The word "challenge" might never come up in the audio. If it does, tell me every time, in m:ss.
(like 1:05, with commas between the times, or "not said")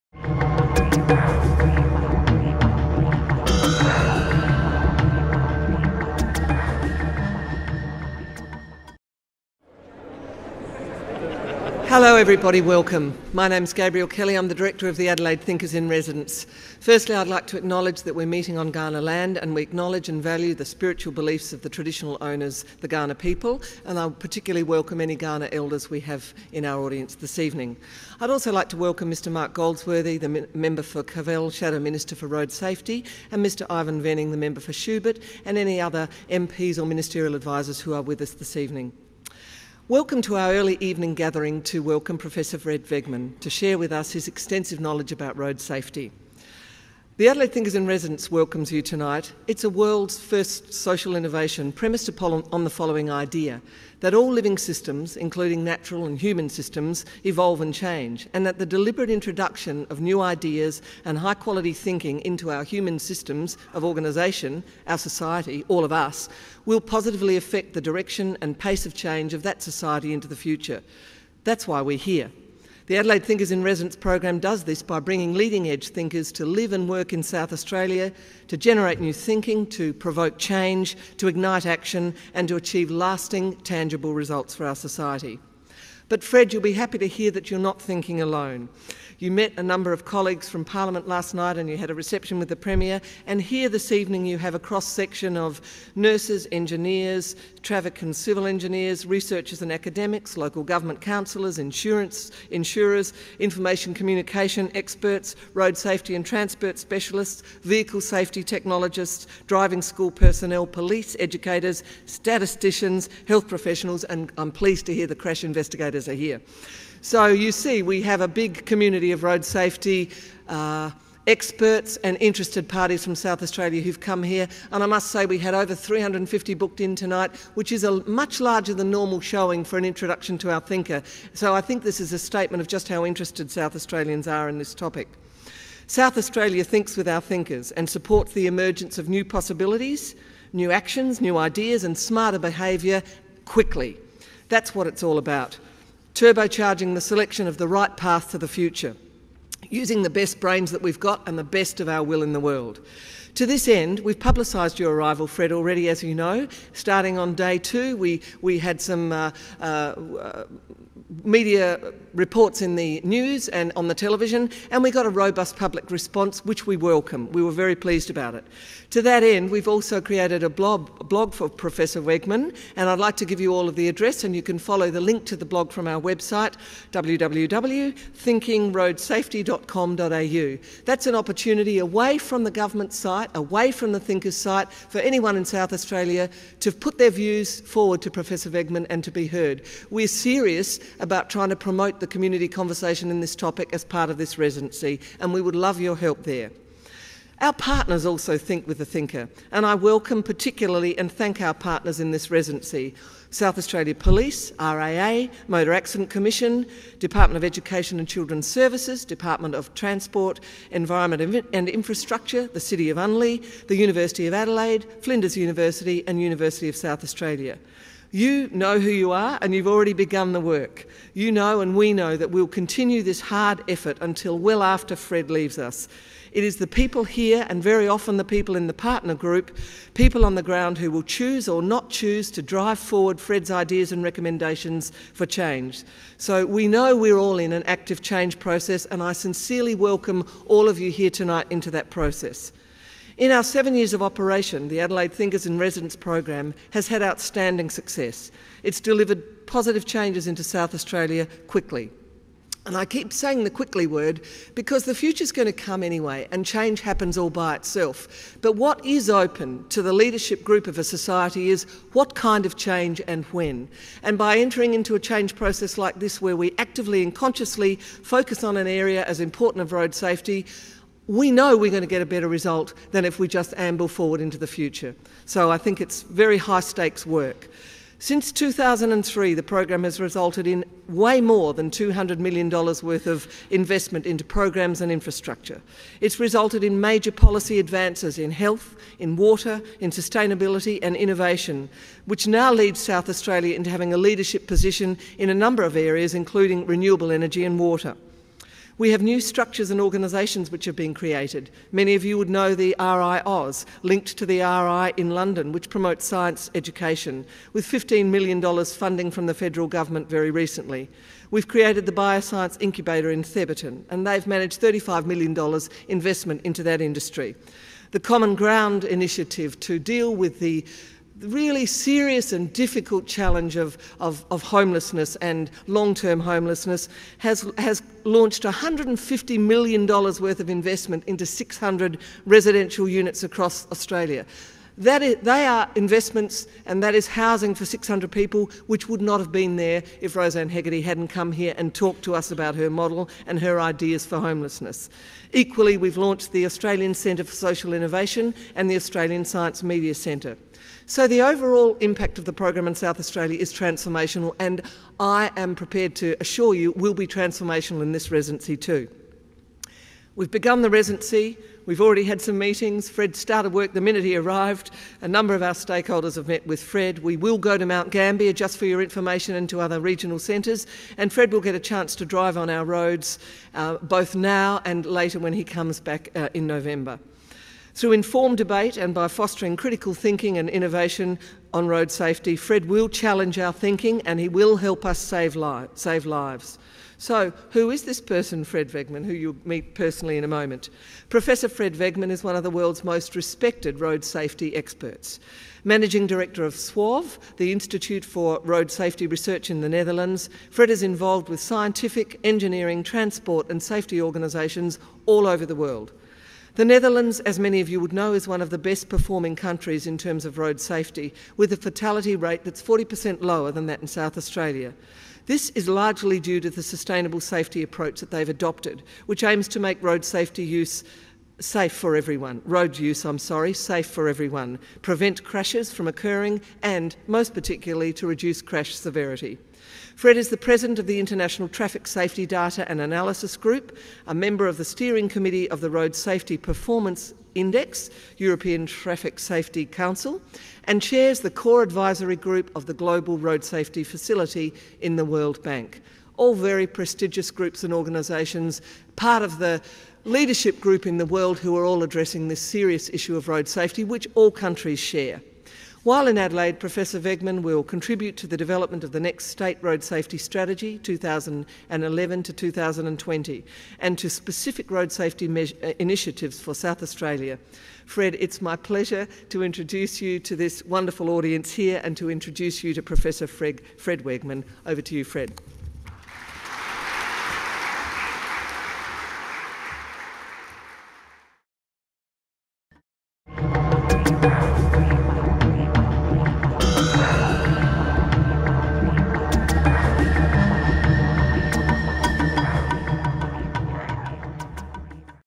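5:23, 6:22.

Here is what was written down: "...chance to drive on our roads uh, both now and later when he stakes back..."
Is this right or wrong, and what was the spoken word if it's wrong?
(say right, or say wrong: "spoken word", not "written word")
wrong: "comes", not "stakes".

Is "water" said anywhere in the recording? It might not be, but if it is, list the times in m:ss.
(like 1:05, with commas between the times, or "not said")
4:49, 4:57.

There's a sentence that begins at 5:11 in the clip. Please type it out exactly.
We've created the Bioscience Incubator in Thebarton, and they've managed $35 million investment into that industry.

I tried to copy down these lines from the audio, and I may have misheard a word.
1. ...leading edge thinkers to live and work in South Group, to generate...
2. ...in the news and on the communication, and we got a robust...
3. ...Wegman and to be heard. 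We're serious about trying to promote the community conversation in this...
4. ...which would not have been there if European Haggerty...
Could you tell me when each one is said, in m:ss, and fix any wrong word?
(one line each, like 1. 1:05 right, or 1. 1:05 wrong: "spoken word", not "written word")
1. 1:15 wrong: "Australia", not "Group"
2. 2:42 wrong: "television", not "communication"
3. 3:08 right
4. 5:38 wrong: "Rosanne", not "European".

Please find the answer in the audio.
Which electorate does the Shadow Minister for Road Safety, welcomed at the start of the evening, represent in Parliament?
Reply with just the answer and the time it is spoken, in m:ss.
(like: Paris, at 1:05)
Kavel, at 0:31.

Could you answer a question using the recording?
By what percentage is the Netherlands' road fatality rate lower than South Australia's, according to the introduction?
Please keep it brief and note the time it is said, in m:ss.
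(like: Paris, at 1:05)
40%, at 6:52.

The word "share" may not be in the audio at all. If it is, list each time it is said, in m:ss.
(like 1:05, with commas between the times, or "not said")
0:43, 7:34.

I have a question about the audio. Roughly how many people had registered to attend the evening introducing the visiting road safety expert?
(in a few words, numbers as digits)
over 350.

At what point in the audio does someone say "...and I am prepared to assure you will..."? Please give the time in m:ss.
5:54.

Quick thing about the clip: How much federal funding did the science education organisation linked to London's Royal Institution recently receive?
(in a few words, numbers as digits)
$15 million.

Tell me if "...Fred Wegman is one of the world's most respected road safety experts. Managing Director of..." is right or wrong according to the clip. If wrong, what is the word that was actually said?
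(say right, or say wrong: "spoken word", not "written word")
right.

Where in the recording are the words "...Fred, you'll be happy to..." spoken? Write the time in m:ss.
1:26.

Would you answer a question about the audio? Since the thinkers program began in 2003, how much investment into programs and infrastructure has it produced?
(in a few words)
$200 million.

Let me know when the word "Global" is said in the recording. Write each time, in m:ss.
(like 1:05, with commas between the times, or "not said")
7:22.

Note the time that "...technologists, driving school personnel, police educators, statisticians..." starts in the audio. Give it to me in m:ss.
1:48.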